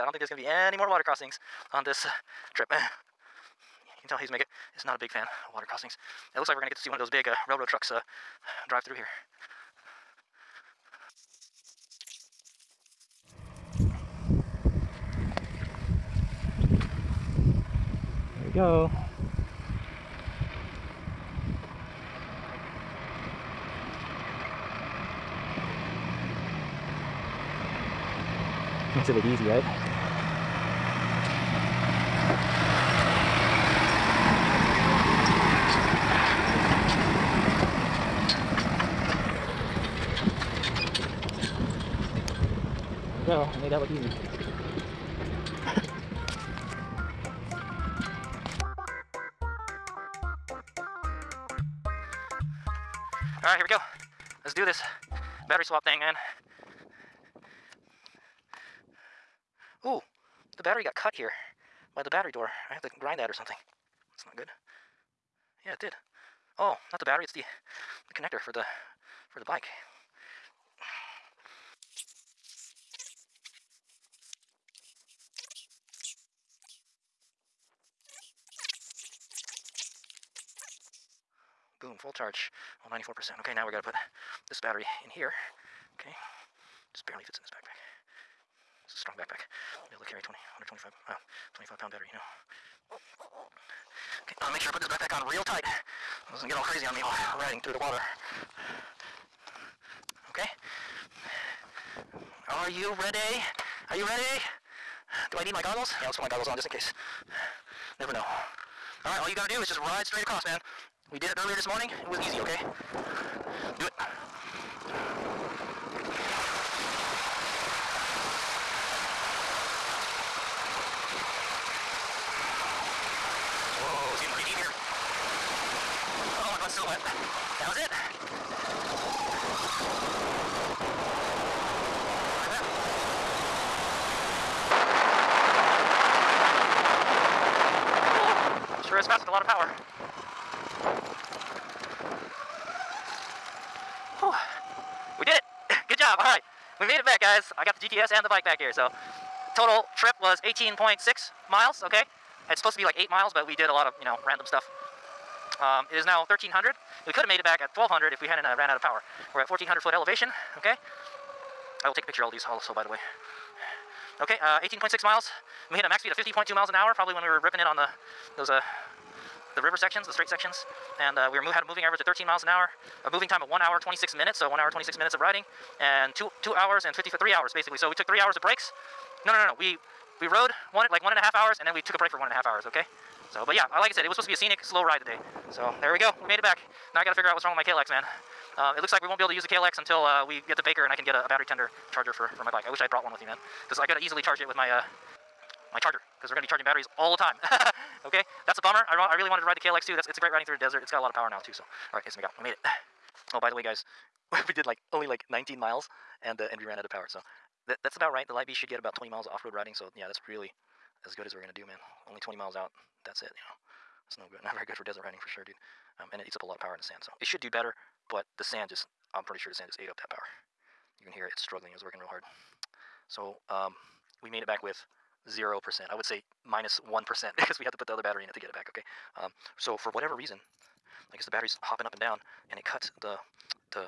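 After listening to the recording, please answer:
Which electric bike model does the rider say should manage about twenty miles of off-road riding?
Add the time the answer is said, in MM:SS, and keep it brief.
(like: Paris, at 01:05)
Light Bee S, at 03:28.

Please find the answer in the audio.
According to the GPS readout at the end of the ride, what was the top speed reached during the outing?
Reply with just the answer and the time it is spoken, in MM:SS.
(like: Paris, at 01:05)
50.2 mph, at 02:46.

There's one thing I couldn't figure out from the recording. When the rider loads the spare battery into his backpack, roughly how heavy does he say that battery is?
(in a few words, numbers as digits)
25 pounds.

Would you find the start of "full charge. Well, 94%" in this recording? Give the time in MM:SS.
01:22.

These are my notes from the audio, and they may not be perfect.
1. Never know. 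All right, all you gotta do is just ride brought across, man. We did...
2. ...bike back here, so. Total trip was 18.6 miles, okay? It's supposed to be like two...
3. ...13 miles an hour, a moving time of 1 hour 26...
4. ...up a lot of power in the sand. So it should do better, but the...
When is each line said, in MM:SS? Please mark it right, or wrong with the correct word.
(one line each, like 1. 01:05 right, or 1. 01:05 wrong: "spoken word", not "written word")
1. 01:48 wrong: "straight", not "brought"
2. 02:28 wrong: "eight", not "two"
3. 02:52 right
4. 03:36 right.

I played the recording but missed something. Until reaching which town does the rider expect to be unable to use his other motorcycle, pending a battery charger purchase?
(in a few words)
Baker.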